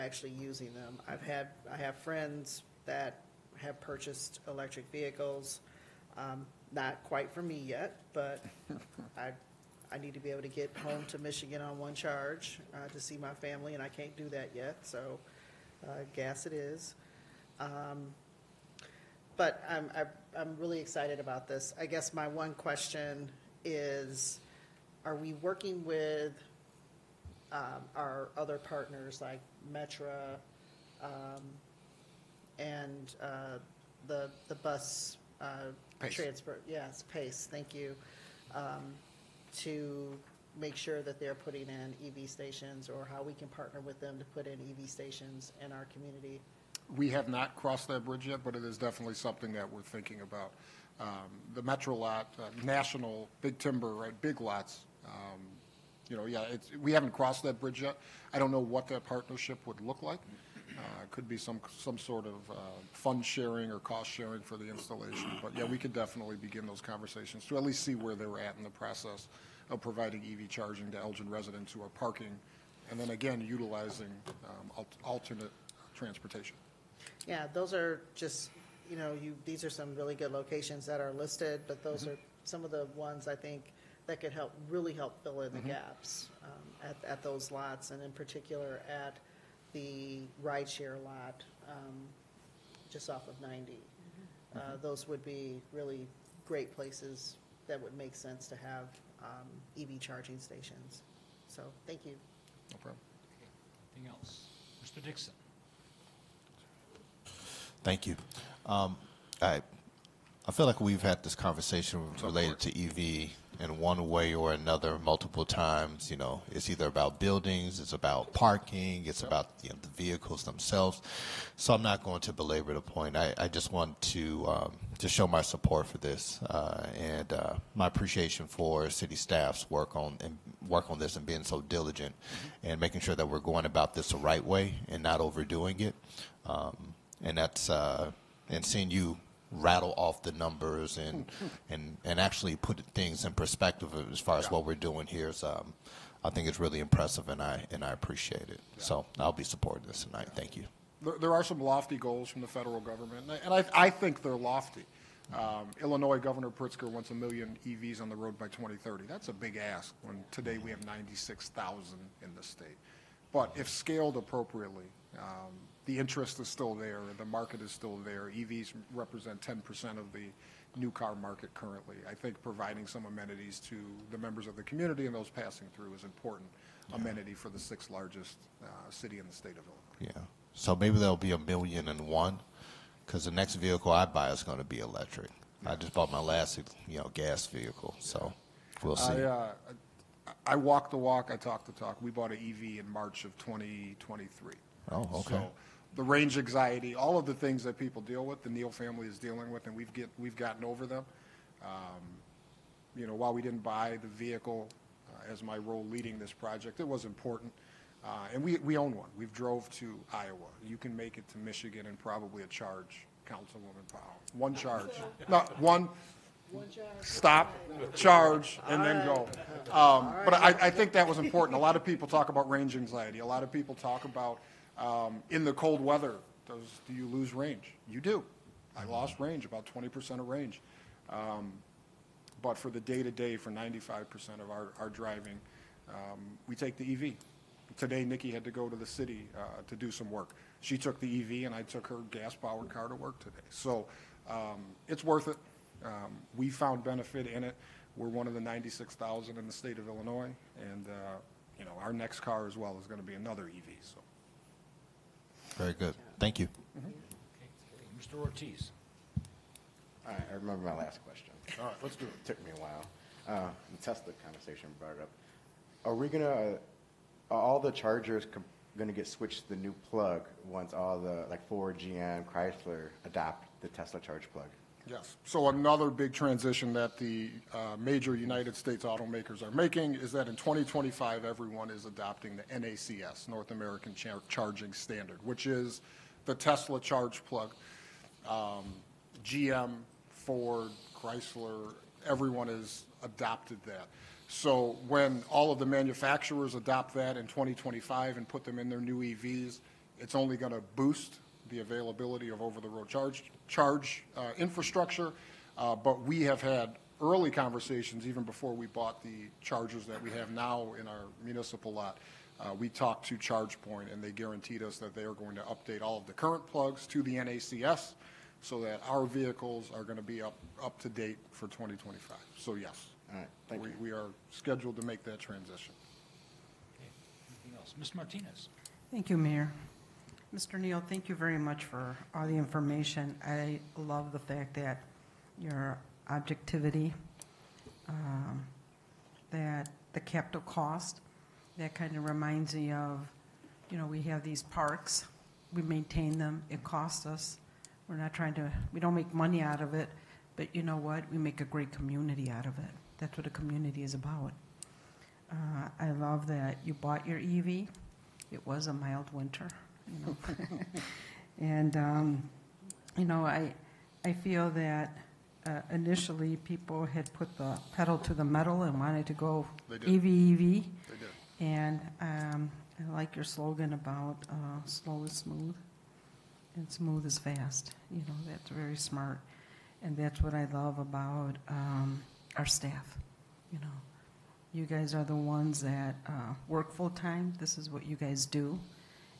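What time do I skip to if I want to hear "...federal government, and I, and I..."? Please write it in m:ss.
2:32.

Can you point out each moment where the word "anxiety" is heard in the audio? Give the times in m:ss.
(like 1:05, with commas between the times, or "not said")
3:16, 3:42.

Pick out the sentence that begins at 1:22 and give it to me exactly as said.
are some of the ones I think that could help, really help fill in the mm -hmm.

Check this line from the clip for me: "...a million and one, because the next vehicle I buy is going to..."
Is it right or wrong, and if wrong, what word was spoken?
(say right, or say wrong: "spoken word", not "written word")
right.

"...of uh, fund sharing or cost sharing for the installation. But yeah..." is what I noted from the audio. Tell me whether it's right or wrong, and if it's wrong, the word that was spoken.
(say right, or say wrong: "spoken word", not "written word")
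right.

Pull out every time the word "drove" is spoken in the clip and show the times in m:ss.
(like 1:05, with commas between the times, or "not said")
3:29.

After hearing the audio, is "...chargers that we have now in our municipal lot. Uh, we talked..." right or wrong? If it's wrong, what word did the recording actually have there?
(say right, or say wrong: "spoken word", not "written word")
right.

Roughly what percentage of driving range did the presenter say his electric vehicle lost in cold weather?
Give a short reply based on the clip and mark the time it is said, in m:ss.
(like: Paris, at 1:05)
20%, at 3:49.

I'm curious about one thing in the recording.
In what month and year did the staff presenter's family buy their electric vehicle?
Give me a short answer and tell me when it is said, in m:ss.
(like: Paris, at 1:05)
March 2023, at 3:12.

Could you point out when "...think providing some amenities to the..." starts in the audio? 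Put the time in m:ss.
2:52.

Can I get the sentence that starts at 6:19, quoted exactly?
And that's what I love about um, our staff.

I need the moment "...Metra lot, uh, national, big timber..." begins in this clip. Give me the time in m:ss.
0:51.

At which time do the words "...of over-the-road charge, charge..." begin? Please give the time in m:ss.
5:02.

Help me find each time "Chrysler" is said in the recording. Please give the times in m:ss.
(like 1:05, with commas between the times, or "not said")
4:32, 4:50.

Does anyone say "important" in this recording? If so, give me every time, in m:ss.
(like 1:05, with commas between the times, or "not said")
2:56, 3:27, 3:41.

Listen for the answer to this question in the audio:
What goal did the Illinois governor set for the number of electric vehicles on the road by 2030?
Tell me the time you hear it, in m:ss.
2:37.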